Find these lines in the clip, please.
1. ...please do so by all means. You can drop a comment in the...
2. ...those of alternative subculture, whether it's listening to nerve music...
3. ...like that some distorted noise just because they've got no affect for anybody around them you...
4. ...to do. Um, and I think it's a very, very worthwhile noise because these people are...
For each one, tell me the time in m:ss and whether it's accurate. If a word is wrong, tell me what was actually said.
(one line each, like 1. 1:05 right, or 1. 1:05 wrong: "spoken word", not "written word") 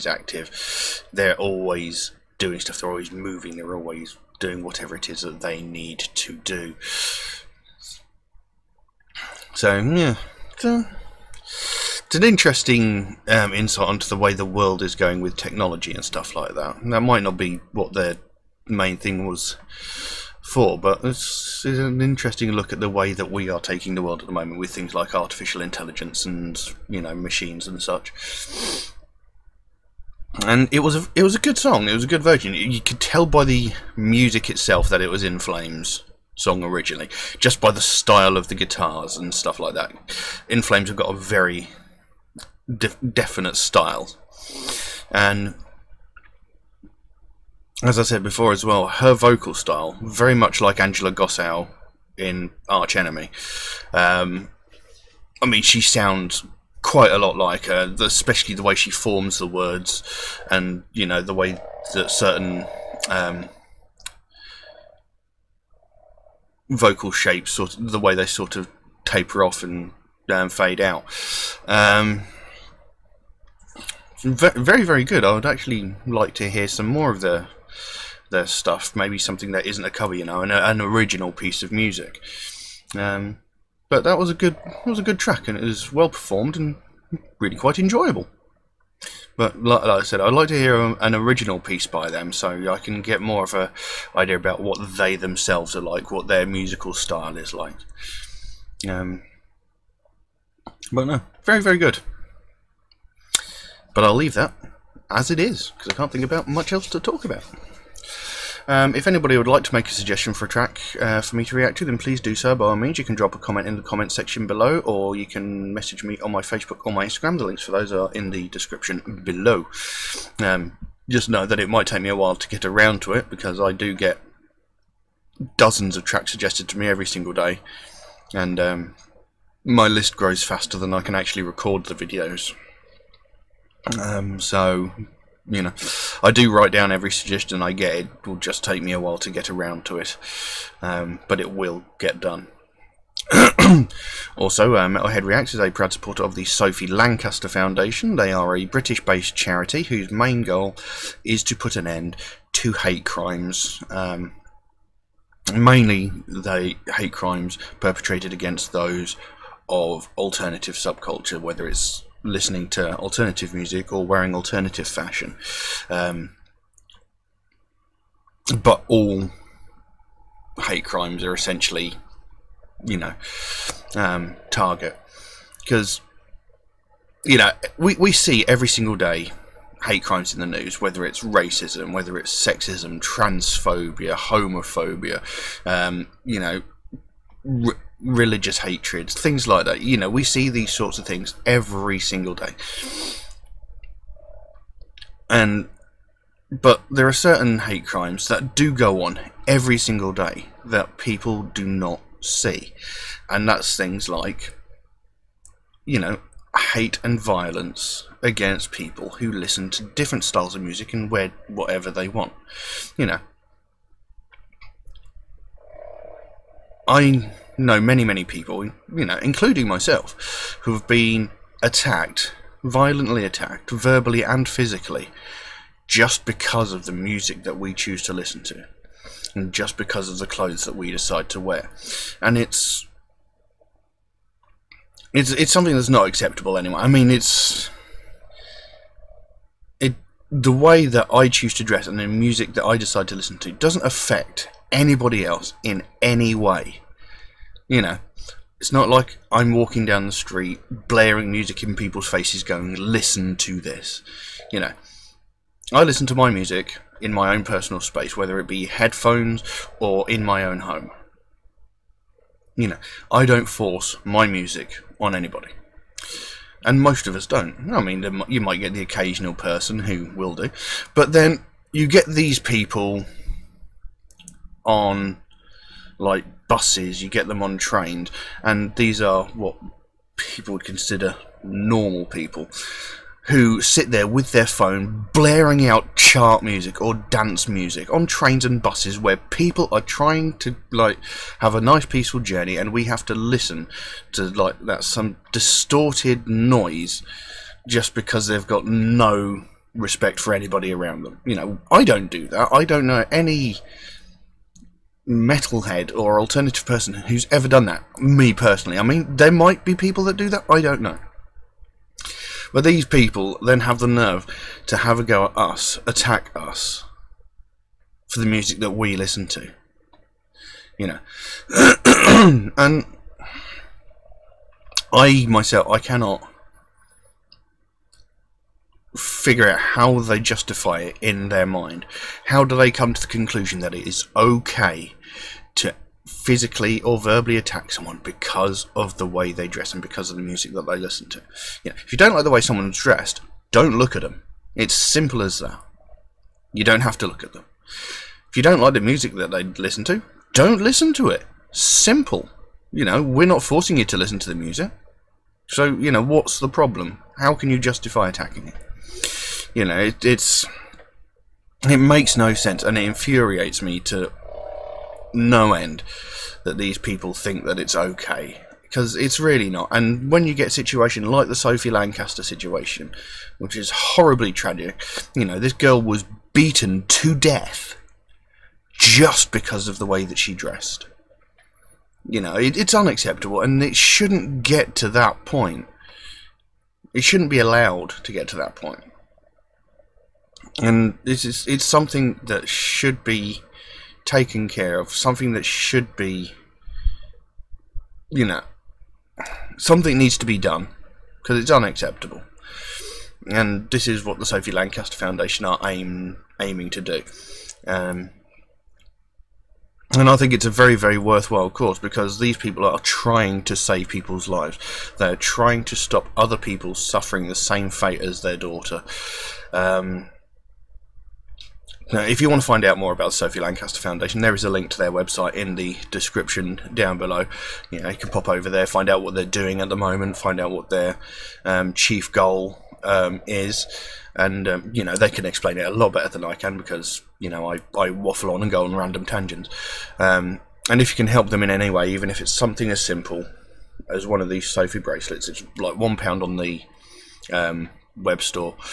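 1. 1:51 right
2. 2:38 wrong: "alternative", not "nerve"
3. 4:54 wrong: "respect", not "affect"
4. 6:46 wrong: "cause", not "noise".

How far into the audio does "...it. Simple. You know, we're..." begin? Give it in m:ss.
5:51.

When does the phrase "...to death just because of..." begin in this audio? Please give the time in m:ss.
6:16.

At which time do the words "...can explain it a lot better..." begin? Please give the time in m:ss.
7:15.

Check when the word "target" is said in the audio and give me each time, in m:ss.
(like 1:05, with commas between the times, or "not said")
2:54.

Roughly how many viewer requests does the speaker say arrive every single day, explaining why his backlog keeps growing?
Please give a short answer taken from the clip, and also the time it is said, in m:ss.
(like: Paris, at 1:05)
dozens, at 2:05.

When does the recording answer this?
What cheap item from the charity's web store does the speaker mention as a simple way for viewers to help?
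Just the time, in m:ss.
7:24.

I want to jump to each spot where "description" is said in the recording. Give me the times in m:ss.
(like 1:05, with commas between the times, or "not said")
1:58, 7:05.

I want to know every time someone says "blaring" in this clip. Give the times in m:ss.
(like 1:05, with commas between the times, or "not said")
4:10, 4:45.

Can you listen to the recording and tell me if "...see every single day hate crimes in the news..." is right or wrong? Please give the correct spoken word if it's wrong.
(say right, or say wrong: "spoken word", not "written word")
right.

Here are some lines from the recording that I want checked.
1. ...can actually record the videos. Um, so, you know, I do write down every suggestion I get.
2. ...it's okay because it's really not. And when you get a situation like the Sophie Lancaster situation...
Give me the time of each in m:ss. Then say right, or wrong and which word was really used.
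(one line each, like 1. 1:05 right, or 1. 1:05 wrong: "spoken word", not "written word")
1. 2:11 right
2. 6:07 right.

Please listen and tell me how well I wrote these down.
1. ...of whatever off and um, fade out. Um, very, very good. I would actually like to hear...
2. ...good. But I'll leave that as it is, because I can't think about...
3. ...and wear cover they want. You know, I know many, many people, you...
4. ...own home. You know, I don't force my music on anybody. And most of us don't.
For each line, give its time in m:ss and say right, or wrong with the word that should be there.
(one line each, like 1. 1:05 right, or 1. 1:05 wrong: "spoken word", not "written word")
1. 1:08 wrong: "taper", not "whatever"
2. 1:41 right
3. 3:30 wrong: "whatever", not "cover"
4. 4:20 right.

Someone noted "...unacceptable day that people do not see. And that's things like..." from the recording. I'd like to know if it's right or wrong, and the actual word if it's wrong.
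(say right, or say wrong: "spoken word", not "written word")
wrong: "single", not "unacceptable".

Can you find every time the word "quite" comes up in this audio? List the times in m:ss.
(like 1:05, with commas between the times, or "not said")
0:56, 1:27.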